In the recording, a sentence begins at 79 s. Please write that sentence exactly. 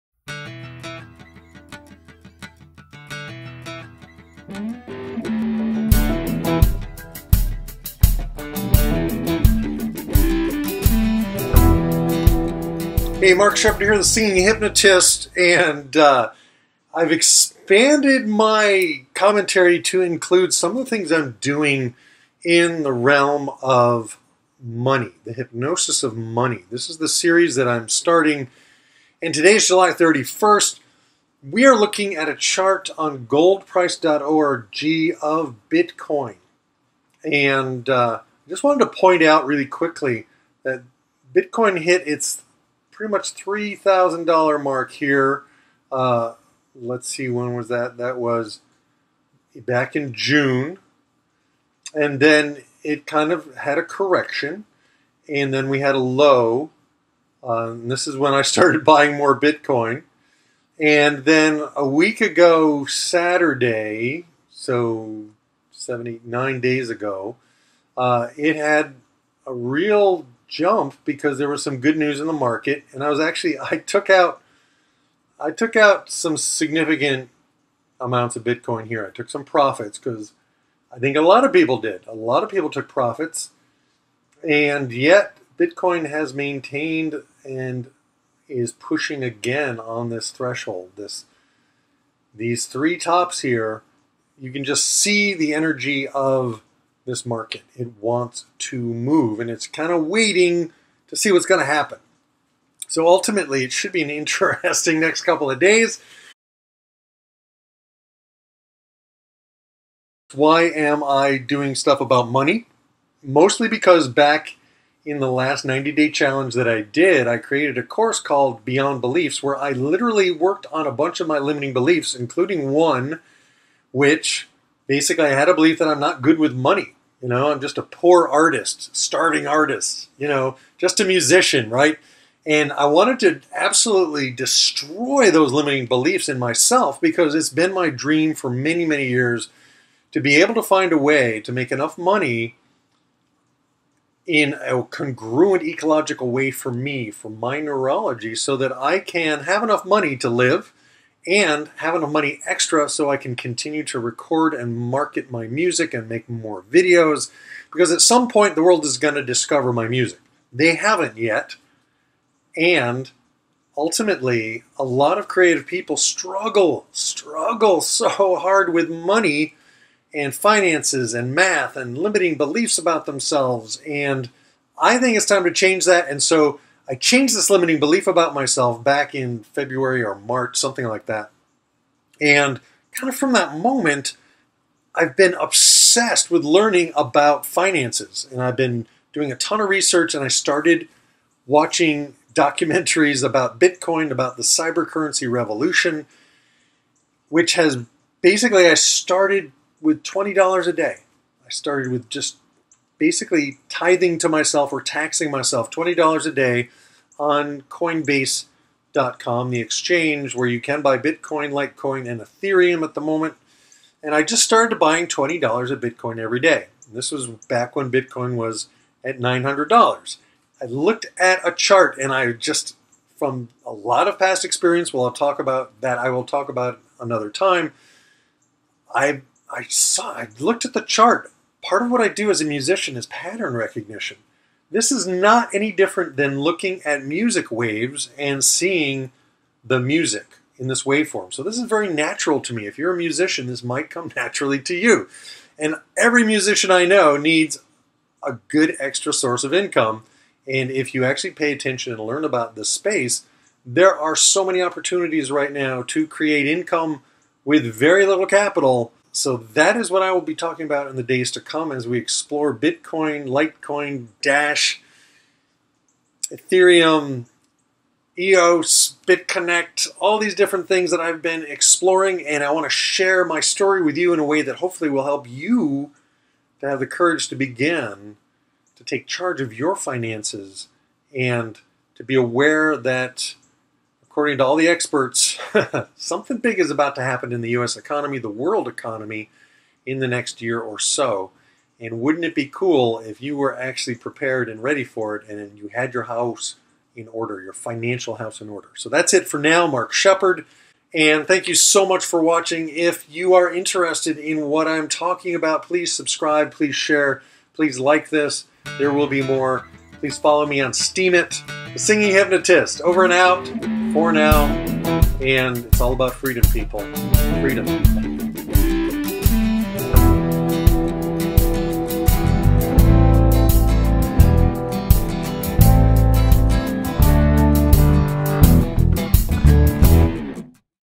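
I took some profits because I think a lot of people did.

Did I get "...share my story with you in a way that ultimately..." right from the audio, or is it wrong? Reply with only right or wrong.
wrong.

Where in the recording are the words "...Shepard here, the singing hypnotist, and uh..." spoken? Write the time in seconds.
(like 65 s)
13 s.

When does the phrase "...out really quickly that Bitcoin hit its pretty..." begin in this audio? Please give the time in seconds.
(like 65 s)
39 s.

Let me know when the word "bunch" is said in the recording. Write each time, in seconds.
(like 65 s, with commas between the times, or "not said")
120 s.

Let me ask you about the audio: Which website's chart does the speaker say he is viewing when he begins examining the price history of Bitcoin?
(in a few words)
goldprice.org.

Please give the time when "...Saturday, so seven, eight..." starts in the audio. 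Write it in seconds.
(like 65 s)
62 s.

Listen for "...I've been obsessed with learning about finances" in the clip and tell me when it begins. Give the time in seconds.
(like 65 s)
184 s.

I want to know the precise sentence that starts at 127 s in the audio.
You know, I'm just a poor artist, starving artist, you know, just a musician, right?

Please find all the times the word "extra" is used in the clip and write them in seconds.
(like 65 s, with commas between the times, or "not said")
152 s, 248 s.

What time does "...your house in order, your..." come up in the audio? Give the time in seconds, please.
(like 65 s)
295 s.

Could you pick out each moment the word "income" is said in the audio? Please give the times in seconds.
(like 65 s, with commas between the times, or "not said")
249 s, 256 s.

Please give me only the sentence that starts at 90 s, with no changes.
This these three tops here, you can just see the energy of this market.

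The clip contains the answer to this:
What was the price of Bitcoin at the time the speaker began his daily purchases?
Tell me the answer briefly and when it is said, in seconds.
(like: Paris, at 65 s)
$900, at 219 s.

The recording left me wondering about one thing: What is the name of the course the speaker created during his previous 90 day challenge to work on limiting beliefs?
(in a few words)
Beyond Beliefs.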